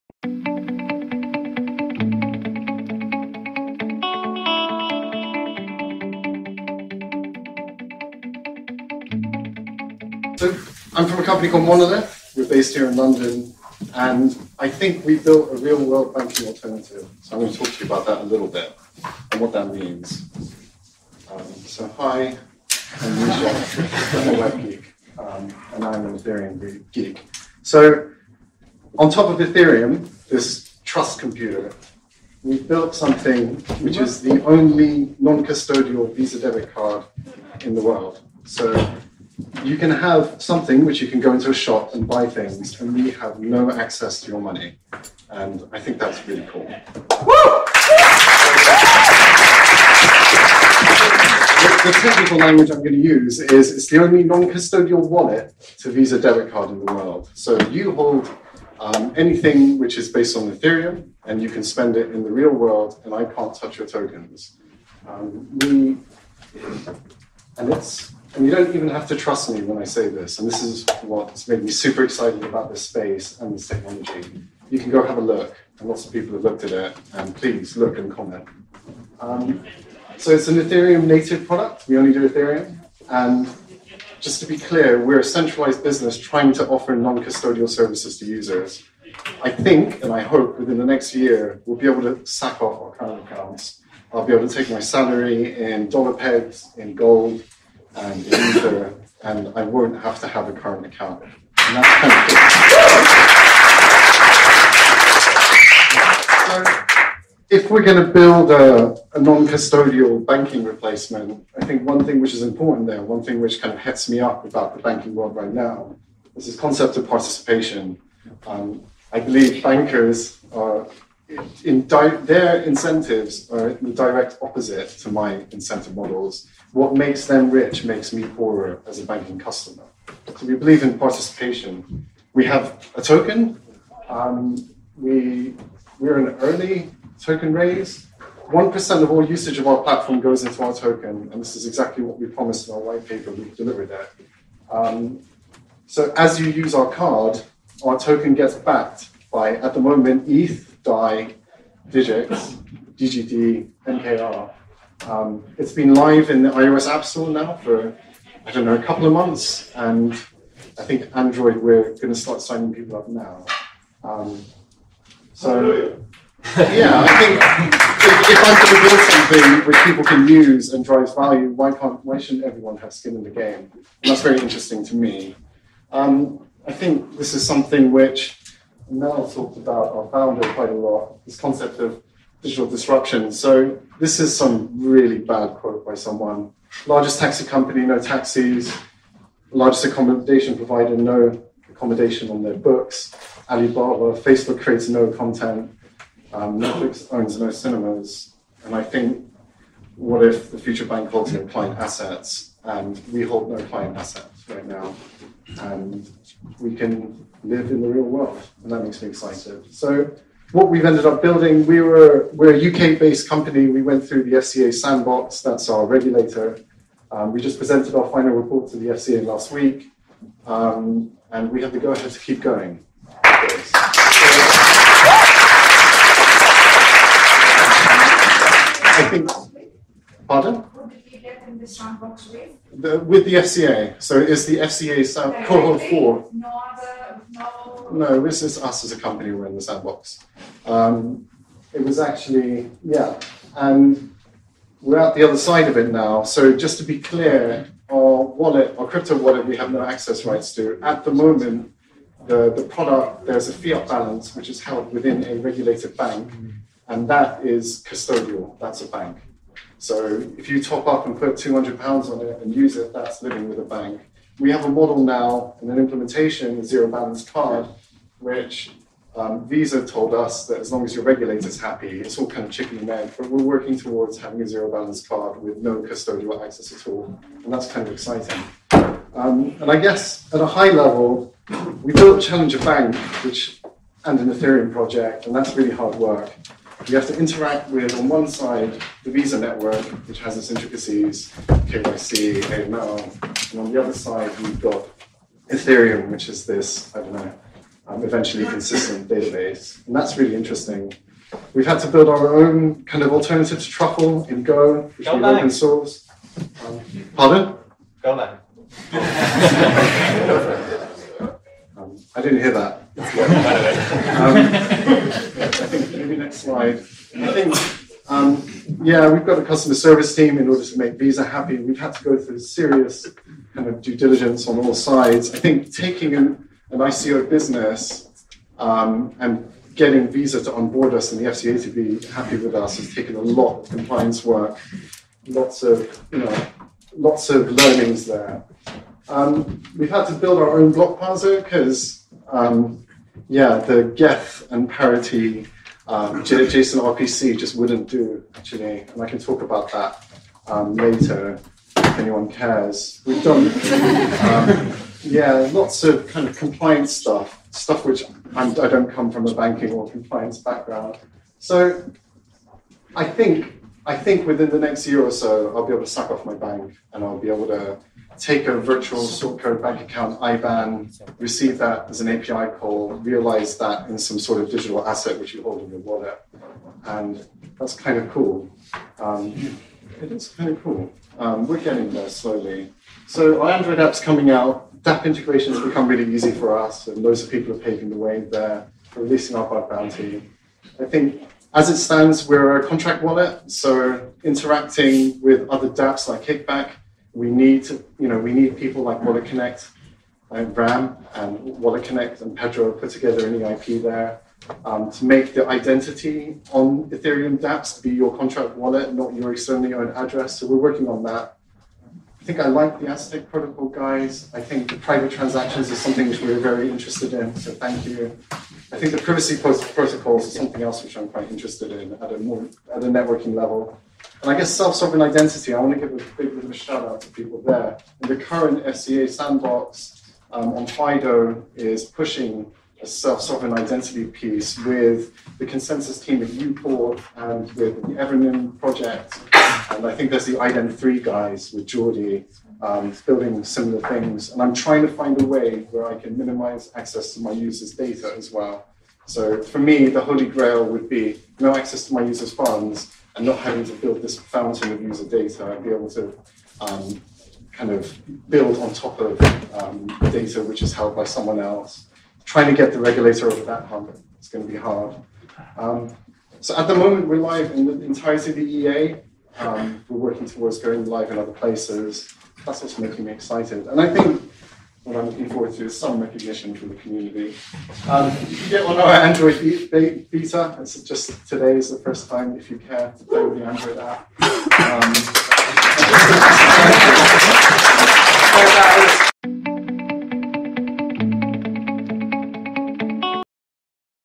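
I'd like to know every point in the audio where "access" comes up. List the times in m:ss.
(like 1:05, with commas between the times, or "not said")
0:43, 4:09, 4:36, 7:26, 7:31.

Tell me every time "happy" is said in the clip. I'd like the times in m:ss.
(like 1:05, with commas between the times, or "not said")
4:31, 5:21, 5:32.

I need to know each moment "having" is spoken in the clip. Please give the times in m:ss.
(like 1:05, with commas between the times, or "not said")
4:34, 7:33.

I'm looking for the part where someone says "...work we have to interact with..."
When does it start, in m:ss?
4:45.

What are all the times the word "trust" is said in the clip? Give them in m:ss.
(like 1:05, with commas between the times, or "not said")
0:30, 1:09.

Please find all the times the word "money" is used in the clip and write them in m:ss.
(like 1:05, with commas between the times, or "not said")
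0:44.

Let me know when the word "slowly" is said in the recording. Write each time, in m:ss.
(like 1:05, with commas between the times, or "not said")
6:22.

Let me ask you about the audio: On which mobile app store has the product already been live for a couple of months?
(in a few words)
iOS App Store.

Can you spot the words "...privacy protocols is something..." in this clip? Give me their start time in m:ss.
6:58.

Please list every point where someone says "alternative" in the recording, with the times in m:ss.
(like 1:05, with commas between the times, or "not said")
0:16, 5:03.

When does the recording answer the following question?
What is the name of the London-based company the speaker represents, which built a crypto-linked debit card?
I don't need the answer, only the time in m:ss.
0:11.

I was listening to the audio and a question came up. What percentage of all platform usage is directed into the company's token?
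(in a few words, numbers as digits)
1%.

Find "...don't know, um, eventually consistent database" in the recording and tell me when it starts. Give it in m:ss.
4:57.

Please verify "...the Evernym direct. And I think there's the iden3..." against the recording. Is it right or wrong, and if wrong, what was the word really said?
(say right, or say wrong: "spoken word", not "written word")
wrong: "project", not "direct".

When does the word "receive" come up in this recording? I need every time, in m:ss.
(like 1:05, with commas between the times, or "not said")
6:11.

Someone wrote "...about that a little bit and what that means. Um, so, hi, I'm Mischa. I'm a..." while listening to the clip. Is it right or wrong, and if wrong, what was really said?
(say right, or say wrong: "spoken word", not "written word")
right.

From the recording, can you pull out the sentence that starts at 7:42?
Trying to get the regulator over that hump is going to be hard.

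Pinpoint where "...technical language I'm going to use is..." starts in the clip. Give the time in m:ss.
0:52.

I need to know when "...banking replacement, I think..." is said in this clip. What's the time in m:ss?
1:50.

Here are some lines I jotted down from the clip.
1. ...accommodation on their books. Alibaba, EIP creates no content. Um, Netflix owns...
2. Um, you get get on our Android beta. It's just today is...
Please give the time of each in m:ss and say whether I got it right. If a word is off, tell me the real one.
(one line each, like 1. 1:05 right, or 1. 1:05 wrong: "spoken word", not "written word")
1. 3:11 wrong: "Facebook", not "EIP"
2. 7:57 right.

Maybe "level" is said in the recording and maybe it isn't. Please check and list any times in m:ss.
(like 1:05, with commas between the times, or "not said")
4:40, 7:03.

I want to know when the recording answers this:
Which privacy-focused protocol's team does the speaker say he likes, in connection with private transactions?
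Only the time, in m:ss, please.
6:52.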